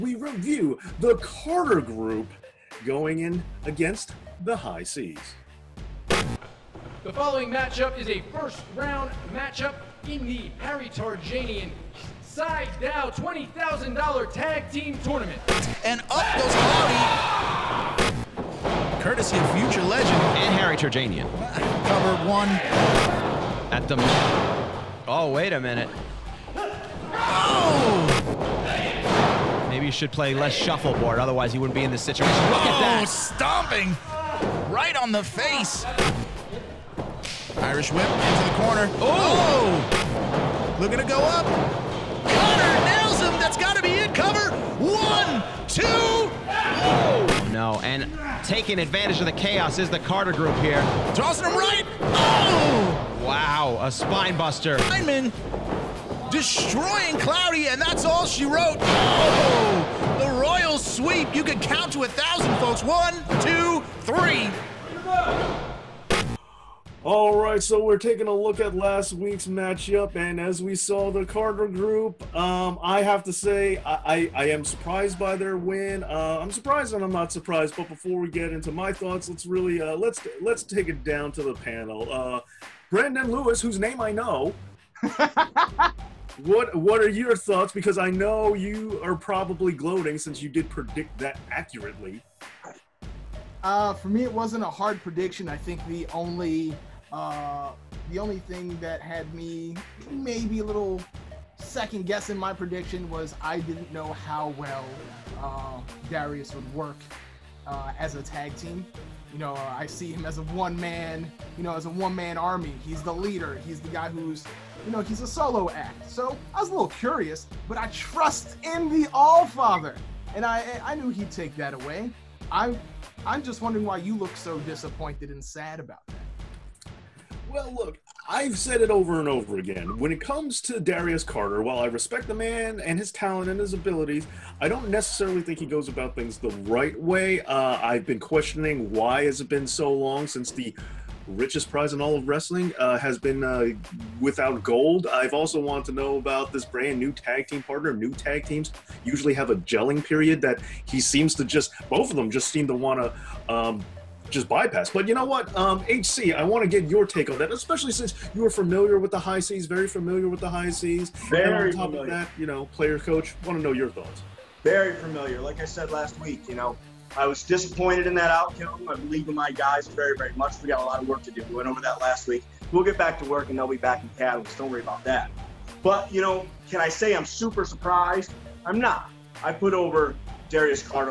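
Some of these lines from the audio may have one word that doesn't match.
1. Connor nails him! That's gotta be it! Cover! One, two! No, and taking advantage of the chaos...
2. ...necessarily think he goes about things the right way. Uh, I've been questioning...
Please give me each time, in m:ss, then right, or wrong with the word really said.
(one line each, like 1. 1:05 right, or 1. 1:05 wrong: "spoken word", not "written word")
1. 0:42 right
2. 2:14 right.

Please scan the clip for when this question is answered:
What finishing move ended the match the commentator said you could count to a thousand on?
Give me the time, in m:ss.
1:00.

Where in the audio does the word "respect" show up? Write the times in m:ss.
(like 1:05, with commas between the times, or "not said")
2:11.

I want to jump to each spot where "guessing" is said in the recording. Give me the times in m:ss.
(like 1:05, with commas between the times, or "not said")
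1:42.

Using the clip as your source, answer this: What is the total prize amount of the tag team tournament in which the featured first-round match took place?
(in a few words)
$20,000.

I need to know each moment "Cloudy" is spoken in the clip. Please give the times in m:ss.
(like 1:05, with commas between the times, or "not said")
0:16, 0:57.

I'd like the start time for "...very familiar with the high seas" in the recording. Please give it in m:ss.
2:39.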